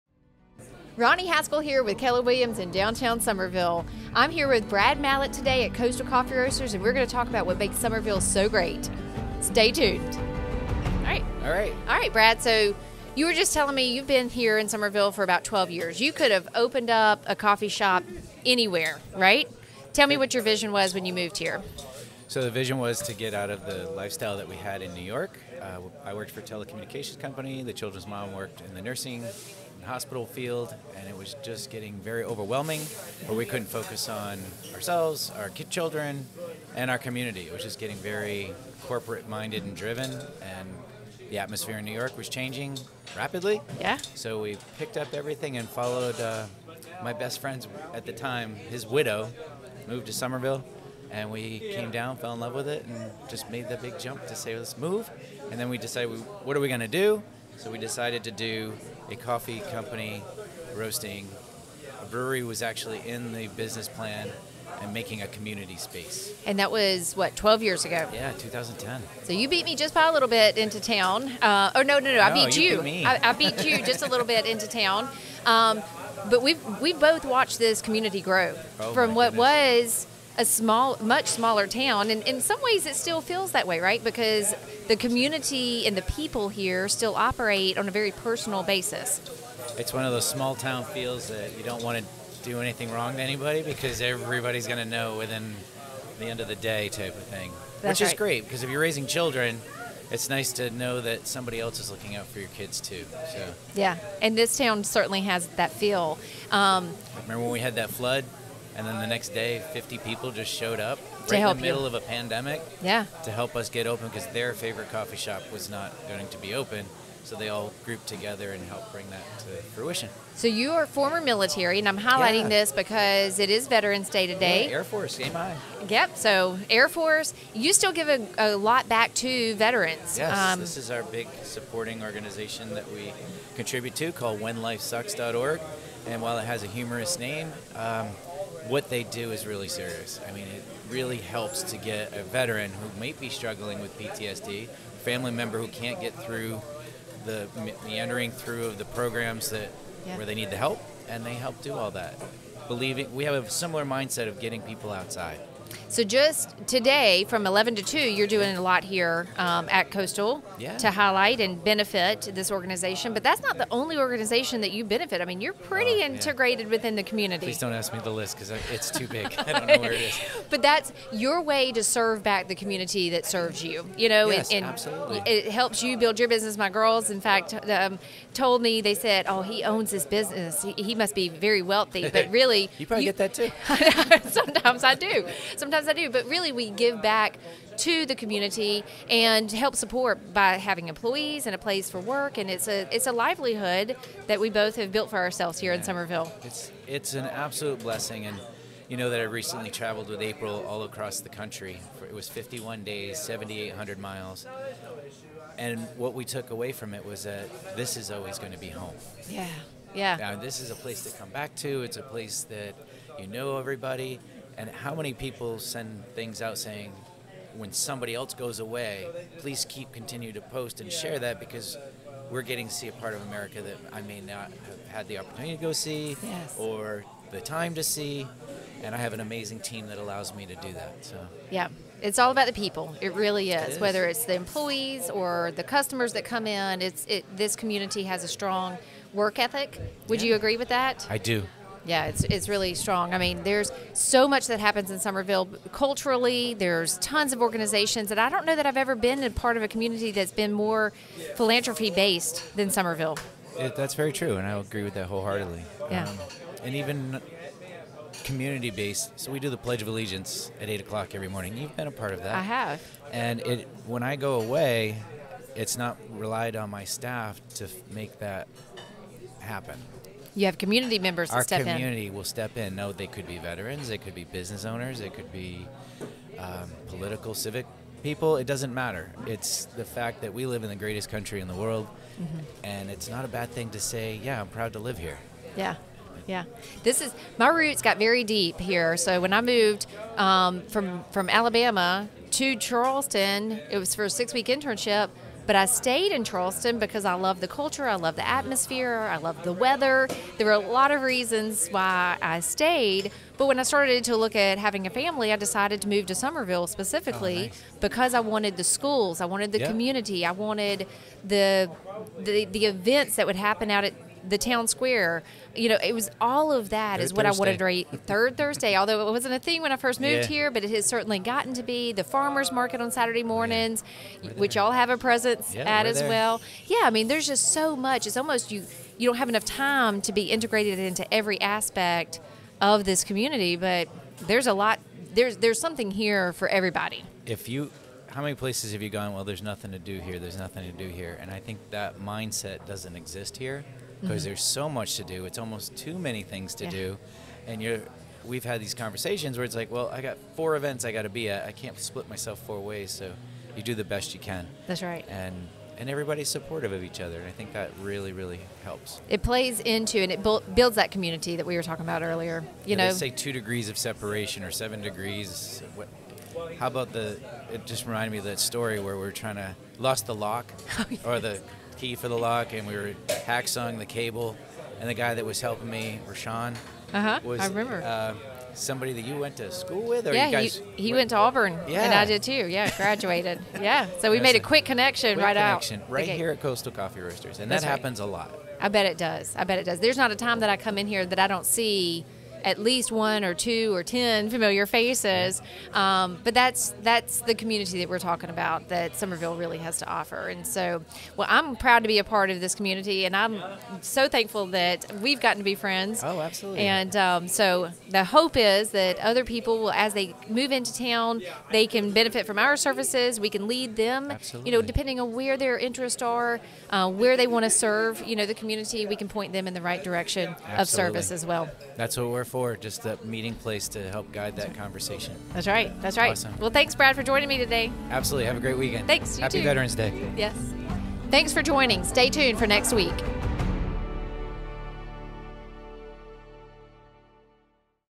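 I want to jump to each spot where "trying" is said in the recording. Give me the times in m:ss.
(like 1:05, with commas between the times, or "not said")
6:09.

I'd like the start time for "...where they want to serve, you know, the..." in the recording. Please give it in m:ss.
6:56.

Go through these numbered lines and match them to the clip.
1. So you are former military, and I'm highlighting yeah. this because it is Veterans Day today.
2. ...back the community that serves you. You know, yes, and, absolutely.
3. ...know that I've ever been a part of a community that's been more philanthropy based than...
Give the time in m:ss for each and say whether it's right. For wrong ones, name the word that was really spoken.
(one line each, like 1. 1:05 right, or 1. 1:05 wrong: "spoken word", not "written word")
1. 2:00 right
2. 2:52 right
3. 4:08 right.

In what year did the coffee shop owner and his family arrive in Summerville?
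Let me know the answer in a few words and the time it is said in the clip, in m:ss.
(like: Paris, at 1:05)
2010, at 1:08.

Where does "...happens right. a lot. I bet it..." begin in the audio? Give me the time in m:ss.
6:27.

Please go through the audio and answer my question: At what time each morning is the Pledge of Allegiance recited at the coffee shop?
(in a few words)
8 o'clock.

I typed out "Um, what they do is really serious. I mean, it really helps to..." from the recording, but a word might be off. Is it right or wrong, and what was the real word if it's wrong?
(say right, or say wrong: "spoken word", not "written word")
right.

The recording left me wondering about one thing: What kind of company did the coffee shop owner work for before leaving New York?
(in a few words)
Telecommunications company.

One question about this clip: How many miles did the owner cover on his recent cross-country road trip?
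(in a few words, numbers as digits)
7800.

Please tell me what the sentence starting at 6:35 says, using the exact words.
Um, but that's that's the community that we're talking about that Summerville really has to offer.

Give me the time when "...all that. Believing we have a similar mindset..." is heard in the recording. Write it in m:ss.
2:31.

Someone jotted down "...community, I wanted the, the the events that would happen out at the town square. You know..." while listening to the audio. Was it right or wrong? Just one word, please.
right.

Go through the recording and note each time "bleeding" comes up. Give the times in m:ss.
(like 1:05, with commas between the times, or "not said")
not said.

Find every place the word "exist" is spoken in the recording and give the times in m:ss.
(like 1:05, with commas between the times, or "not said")
5:42.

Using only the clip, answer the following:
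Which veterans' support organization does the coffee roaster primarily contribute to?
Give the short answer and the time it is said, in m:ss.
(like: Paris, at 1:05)
WhenLifeSucks.org, at 2:14.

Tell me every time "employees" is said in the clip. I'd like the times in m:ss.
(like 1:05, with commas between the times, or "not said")
3:10, 3:54.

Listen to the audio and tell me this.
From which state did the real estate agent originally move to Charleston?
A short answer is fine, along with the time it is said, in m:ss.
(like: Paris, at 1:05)
Alabama, at 4:51.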